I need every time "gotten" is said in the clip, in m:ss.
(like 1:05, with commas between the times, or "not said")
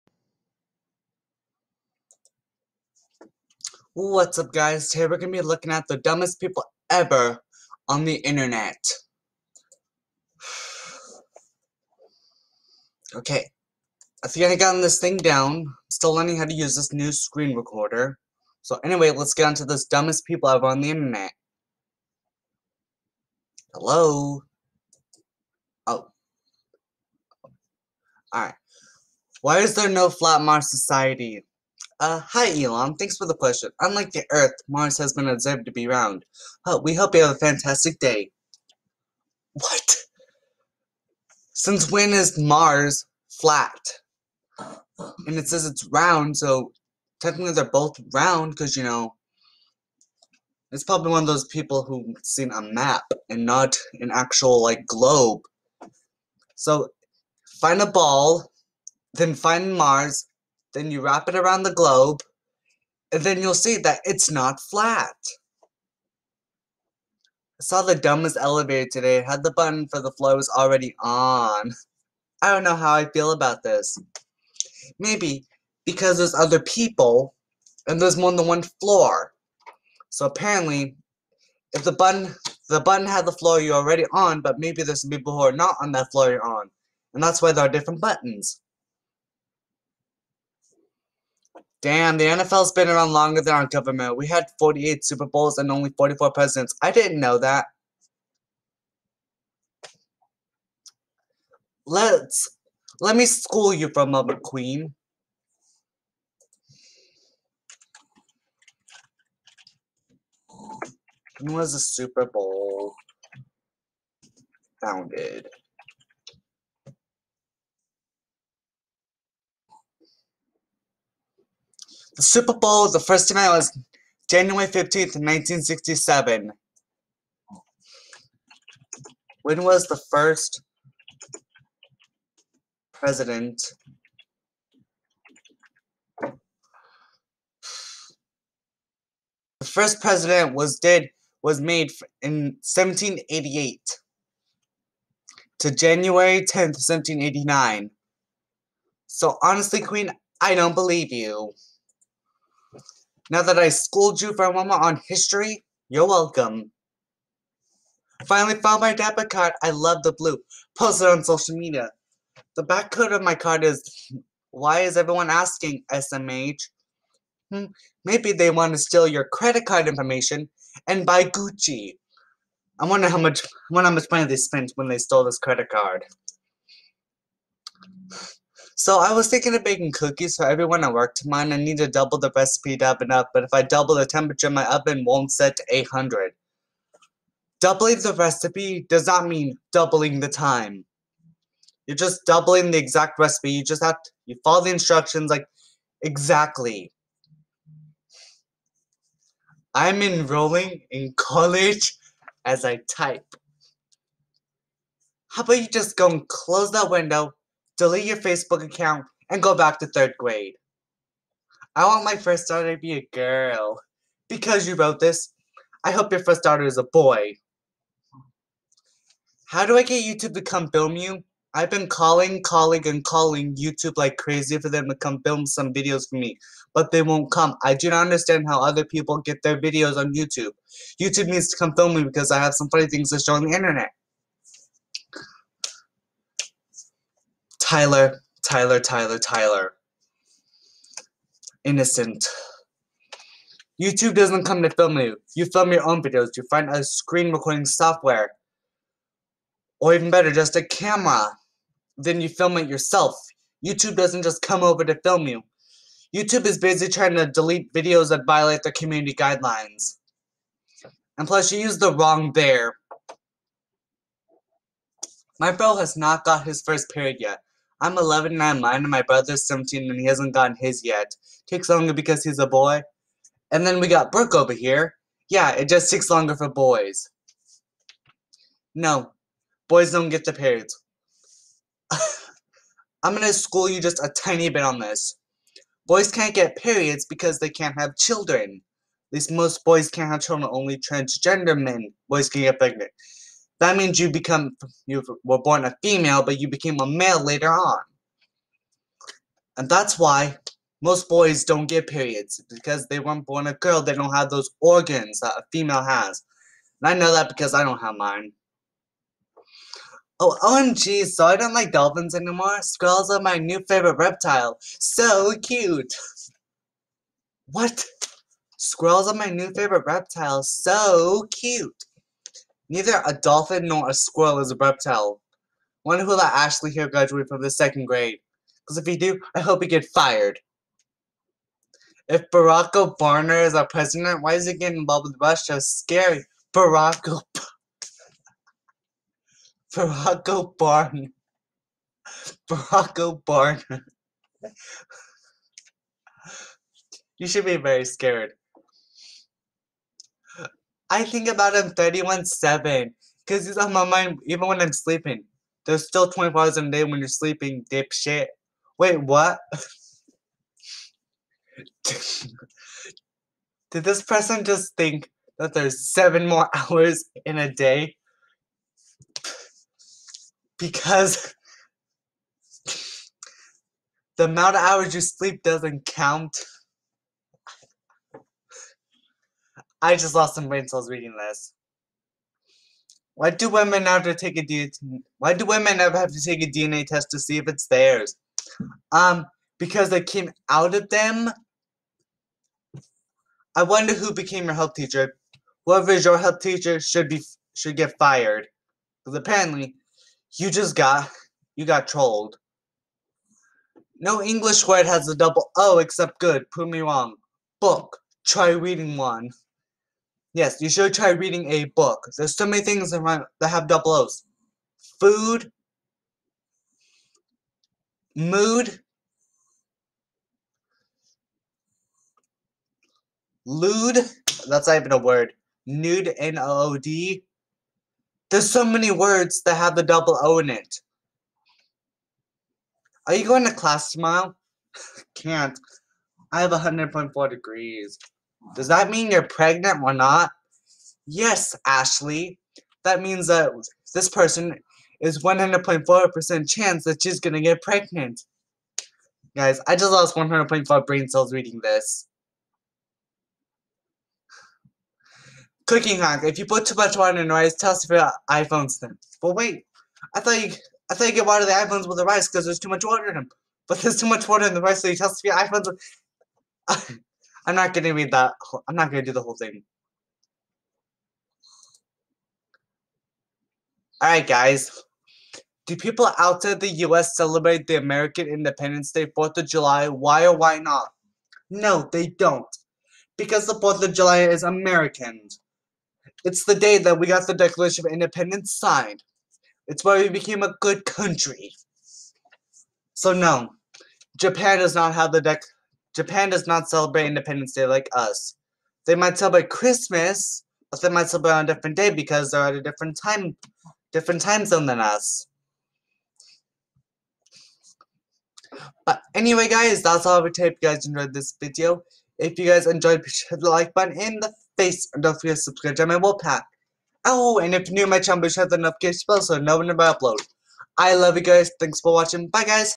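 0:14, 4:30.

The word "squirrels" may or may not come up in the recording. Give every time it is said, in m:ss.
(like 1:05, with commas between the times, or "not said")
5:12, 5:18, 5:23.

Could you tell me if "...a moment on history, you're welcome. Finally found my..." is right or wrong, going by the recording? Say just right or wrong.
right.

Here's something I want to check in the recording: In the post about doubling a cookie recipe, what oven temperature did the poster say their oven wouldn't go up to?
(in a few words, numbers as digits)
800.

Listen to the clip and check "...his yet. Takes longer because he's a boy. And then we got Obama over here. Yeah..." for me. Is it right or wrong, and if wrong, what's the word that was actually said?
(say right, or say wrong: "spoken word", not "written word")
wrong: "Brooke", not "Obama".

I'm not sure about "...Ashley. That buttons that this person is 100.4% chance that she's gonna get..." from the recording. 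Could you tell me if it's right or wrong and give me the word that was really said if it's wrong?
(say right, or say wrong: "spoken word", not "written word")
wrong: "means", not "buttons".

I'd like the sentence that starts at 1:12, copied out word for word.
I don't know how I feel about this.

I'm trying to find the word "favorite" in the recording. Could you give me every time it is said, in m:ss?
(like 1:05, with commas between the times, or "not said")
5:13, 5:19.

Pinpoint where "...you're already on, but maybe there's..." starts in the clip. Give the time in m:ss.
1:23.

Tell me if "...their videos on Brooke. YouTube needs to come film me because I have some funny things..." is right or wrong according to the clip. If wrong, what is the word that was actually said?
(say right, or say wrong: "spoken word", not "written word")
wrong: "YouTube", not "Brooke".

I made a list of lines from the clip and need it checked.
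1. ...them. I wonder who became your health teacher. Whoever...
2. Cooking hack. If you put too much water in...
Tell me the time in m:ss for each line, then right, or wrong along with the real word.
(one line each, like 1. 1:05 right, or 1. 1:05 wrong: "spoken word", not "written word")
1. 6:30 right
2. 7:35 right.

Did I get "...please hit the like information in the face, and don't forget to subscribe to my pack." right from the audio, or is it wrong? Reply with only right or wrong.
wrong.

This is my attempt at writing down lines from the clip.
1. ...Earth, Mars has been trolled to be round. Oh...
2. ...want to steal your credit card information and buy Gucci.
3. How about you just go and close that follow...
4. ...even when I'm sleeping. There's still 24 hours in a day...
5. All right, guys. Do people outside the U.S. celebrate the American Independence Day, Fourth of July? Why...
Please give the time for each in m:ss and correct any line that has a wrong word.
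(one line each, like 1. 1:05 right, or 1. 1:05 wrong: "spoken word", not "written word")
1. 0:34 wrong: "observed", not "trolled"
2. 2:48 right
3. 3:25 wrong: "window", not "follow"
4. 5:54 right
5. 7:54 right.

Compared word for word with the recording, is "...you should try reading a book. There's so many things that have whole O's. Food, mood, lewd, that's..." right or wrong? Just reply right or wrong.
wrong.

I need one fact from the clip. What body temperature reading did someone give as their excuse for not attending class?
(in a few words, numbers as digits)
100.4 degrees.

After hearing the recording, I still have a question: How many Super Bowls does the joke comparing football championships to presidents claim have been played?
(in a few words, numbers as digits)
48.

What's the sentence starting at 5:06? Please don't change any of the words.
And I know that because I don't have mine.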